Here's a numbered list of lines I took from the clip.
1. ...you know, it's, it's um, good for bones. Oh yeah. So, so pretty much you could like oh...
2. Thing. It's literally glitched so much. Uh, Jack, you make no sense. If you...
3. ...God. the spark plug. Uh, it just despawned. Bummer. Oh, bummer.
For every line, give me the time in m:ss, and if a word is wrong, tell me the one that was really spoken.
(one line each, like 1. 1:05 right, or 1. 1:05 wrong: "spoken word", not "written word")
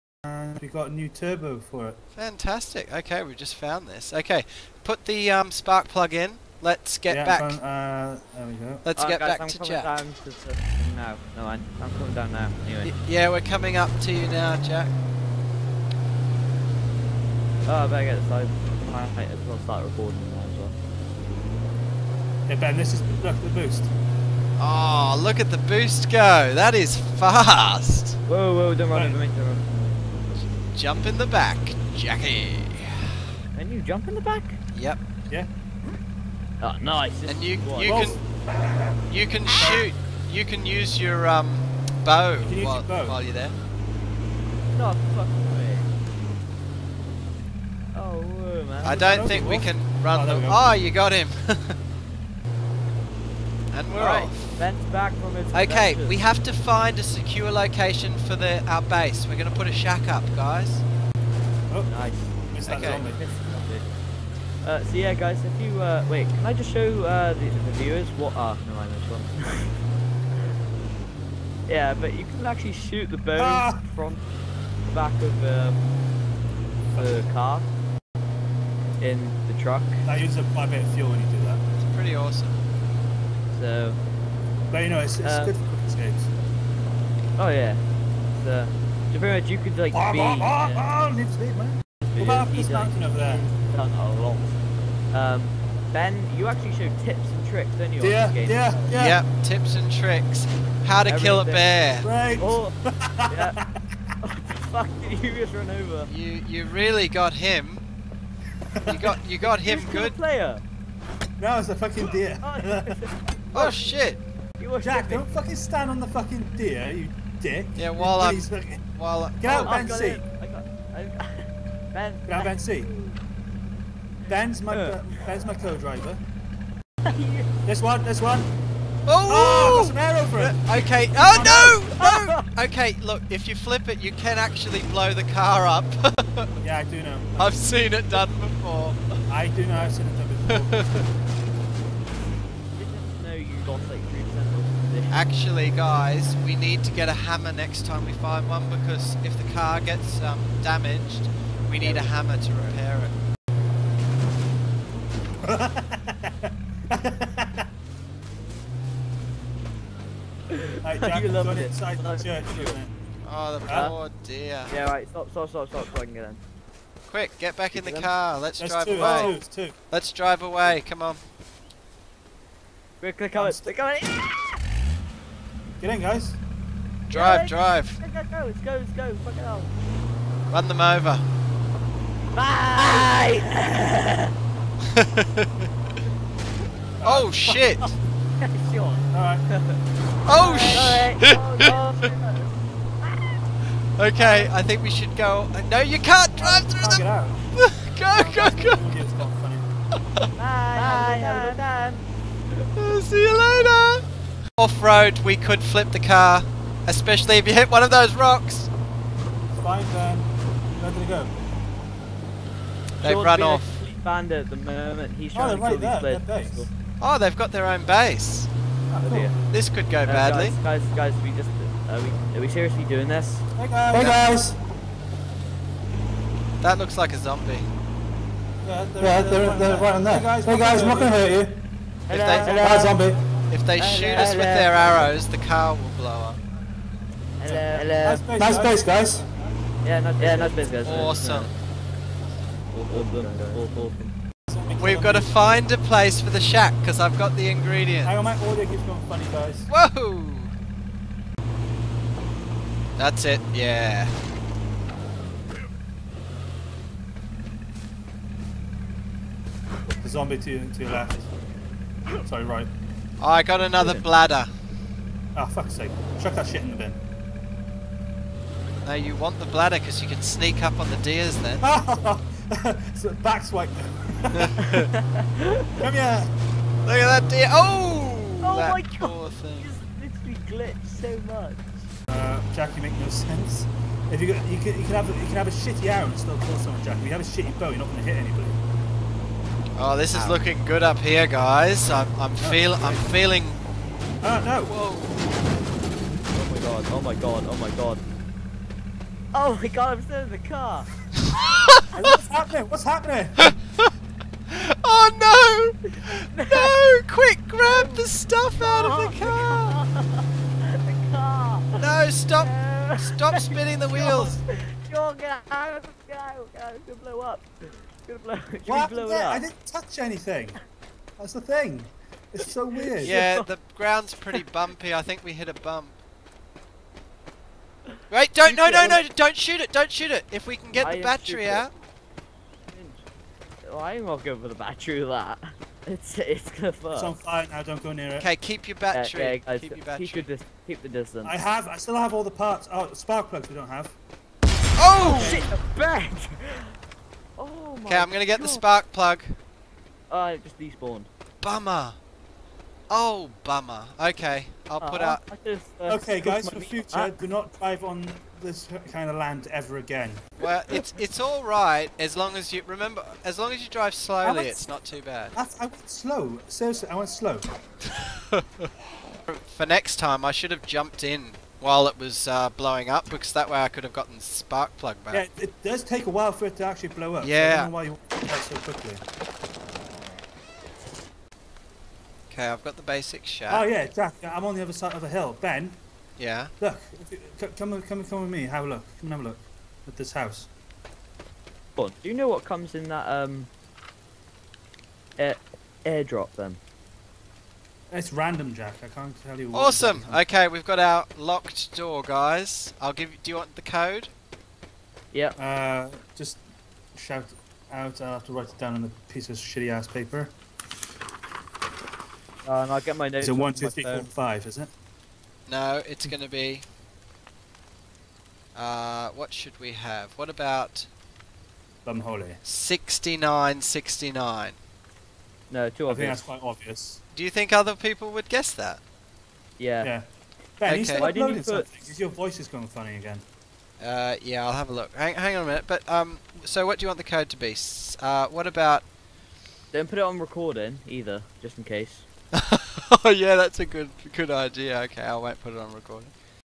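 1. 1:24 wrong: "escapes", not "bones"
2. 4:39 right
3. 5:48 right.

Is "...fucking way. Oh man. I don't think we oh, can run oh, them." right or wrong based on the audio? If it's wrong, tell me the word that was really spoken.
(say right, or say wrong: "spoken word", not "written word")
right.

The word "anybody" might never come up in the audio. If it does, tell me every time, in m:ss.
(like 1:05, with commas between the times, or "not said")
4:48.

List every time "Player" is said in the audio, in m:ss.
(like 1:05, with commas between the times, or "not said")
1:50.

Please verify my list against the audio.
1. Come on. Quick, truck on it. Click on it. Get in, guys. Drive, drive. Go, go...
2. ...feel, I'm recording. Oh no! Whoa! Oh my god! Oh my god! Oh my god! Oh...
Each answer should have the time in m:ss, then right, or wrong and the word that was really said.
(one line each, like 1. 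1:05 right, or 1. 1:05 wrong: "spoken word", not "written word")
1. 2:50 wrong: "click", not "truck"
2. 4:52 wrong: "feeling", not "recording".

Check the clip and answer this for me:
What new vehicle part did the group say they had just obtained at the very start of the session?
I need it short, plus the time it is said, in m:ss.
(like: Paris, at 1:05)
turbo, at 0:01.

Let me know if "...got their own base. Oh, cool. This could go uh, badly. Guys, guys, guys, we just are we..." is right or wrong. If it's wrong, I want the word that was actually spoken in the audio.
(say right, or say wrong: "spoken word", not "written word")
right.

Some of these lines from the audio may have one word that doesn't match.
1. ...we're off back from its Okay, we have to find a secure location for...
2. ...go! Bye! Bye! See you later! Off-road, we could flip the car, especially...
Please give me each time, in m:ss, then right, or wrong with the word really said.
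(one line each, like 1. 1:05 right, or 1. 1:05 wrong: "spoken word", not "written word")
1. 0:53 right
2. 3:18 right.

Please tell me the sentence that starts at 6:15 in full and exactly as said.
Yeah, it does take a while for it to actually blow up.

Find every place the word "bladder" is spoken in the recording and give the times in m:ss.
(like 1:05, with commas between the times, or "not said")
4:23, 4:29.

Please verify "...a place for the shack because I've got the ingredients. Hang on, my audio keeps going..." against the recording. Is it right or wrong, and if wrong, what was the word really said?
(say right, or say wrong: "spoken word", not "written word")
right.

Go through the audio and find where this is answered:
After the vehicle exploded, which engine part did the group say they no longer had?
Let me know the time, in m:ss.
5:42.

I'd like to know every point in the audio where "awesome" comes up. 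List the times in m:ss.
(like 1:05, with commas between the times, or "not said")
1:22, 4:00, 6:39.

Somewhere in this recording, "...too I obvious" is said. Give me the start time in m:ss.
7:05.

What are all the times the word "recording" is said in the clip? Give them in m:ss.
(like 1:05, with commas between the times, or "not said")
0:19, 7:20, 7:25.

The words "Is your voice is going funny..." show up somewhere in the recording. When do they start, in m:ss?
7:11.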